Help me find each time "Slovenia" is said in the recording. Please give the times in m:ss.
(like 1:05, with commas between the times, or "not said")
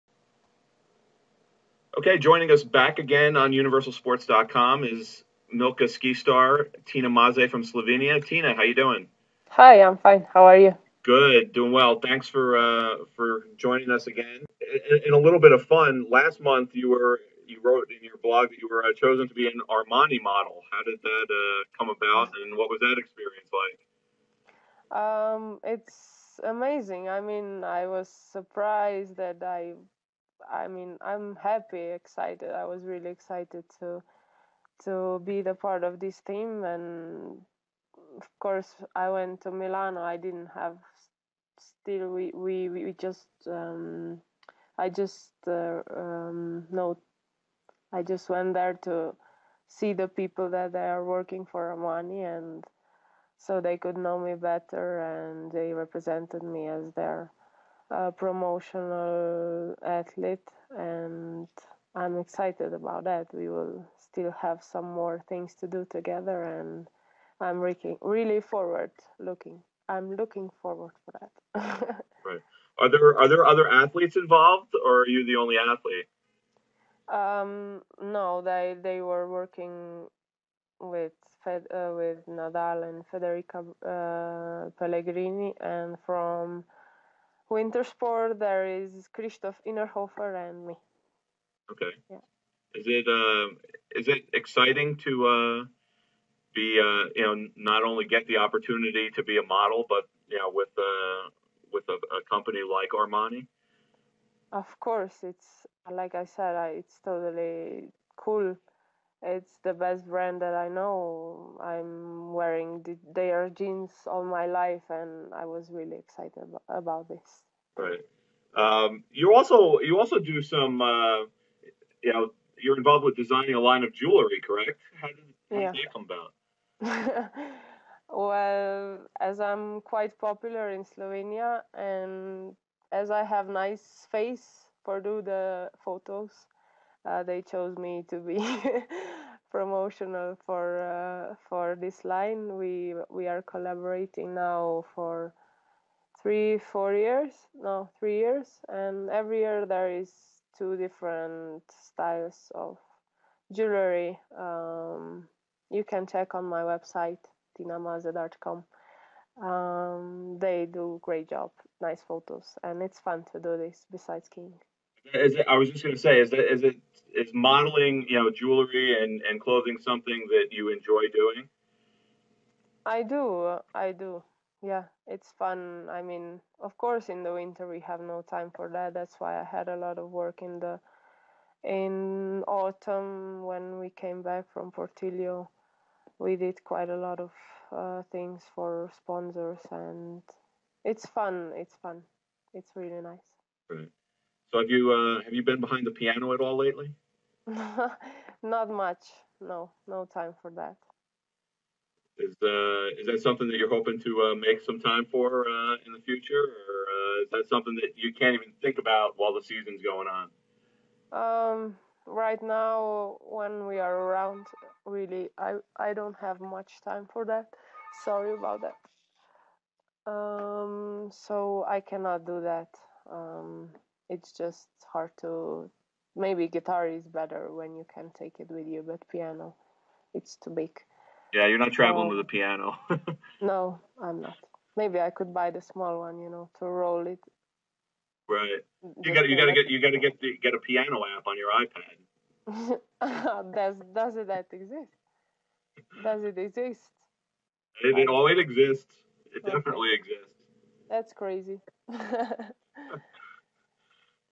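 0:07, 2:10.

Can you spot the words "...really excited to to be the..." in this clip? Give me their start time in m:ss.
0:32.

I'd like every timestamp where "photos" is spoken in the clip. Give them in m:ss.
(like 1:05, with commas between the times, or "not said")
2:15, 2:42.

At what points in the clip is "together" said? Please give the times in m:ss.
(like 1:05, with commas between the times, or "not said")
1:05.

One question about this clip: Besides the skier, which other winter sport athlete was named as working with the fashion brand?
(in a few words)
Christoph Innerhofer.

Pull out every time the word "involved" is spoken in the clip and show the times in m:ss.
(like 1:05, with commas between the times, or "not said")
1:14, 2:02.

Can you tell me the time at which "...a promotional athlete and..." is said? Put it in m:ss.
0:57.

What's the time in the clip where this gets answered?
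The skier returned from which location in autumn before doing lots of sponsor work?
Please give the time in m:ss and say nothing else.
3:04.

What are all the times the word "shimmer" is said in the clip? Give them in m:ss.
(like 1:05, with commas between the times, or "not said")
not said.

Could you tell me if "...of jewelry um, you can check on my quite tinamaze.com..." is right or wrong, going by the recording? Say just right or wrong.
wrong.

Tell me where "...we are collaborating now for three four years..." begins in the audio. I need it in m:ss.
2:23.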